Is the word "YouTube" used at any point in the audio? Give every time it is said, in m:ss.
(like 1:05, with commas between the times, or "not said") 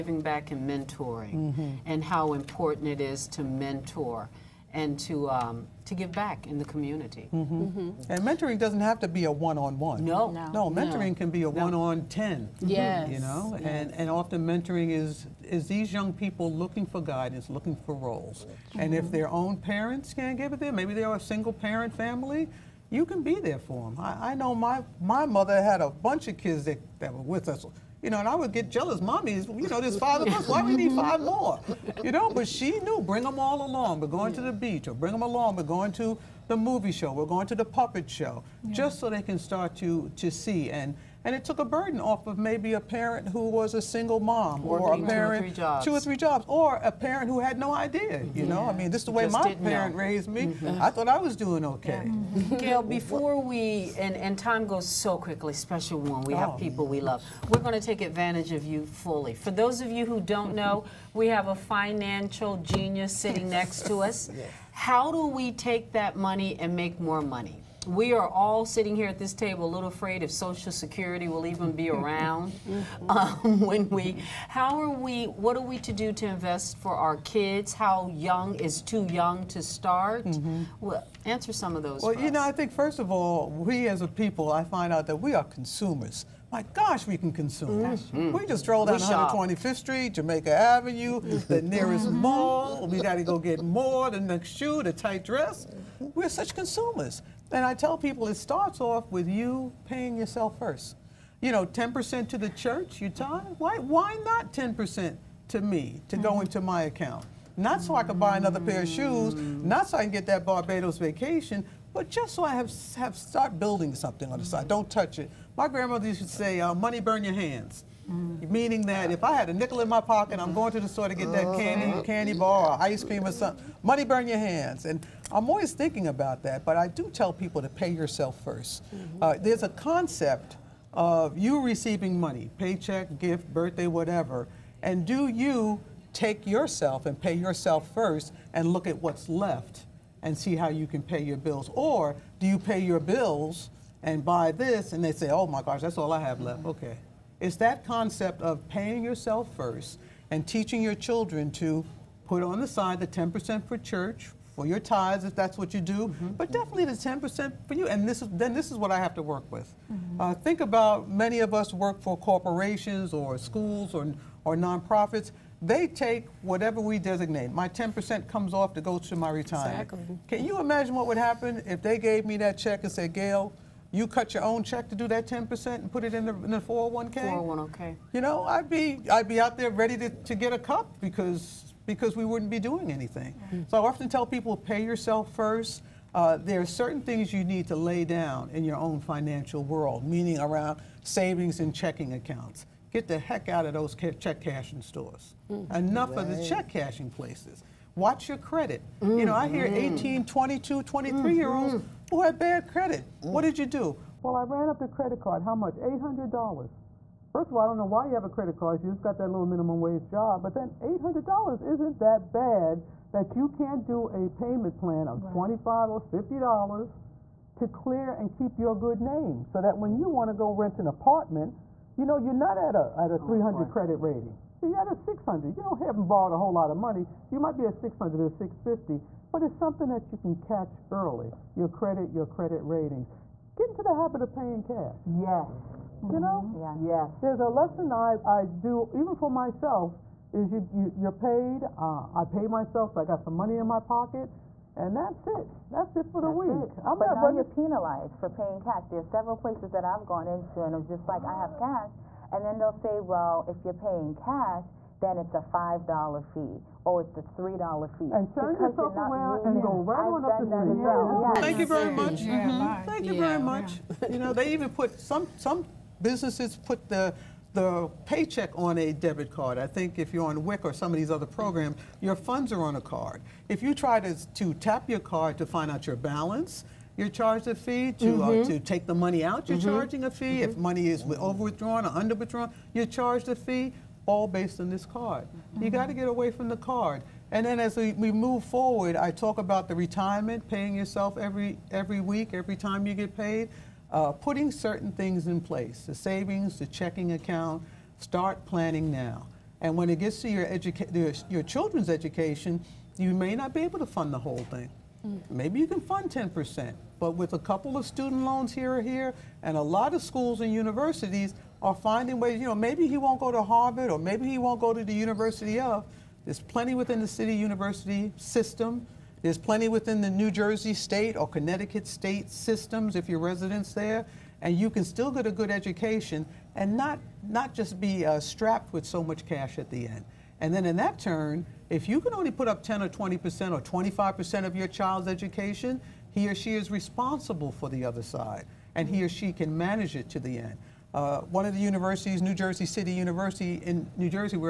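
not said.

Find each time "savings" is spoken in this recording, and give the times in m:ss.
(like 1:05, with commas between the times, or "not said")
3:11, 4:55.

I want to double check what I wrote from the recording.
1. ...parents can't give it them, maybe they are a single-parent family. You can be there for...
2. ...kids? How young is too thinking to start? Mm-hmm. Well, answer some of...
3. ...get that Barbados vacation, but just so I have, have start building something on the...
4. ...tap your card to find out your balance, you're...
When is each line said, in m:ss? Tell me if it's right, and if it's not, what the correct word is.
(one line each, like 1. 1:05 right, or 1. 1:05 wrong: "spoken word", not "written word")
1. 0:19 right
2. 1:17 wrong: "young", not "thinking"
3. 1:50 right
4. 4:34 right.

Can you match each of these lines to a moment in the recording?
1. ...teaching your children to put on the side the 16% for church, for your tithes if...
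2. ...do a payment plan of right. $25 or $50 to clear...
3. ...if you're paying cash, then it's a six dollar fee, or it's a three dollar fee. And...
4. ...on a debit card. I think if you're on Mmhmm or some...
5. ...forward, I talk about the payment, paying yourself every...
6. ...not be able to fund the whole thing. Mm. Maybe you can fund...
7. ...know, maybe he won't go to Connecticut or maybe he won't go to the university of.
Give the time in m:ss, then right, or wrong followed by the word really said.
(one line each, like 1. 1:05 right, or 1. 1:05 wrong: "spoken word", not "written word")
1. 2:30 wrong: "10", not "16"
2. 3:33 right
3. 4:13 wrong: "five", not "six"
4. 4:28 wrong: "WIC", not "Mmhmm"
5. 4:48 wrong: "retirement", not "payment"
6. 5:03 right
7. 5:12 wrong: "Harvard", not "Connecticut".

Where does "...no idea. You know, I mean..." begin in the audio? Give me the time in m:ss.
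0:47.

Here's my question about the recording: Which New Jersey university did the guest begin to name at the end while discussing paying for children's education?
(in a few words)
New Jersey City University.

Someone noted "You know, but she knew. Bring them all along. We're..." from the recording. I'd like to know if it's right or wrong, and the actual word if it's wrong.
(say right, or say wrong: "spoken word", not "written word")
right.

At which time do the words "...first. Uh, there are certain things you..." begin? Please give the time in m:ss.
3:05.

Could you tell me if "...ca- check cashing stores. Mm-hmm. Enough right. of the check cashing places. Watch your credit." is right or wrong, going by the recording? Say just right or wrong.
right.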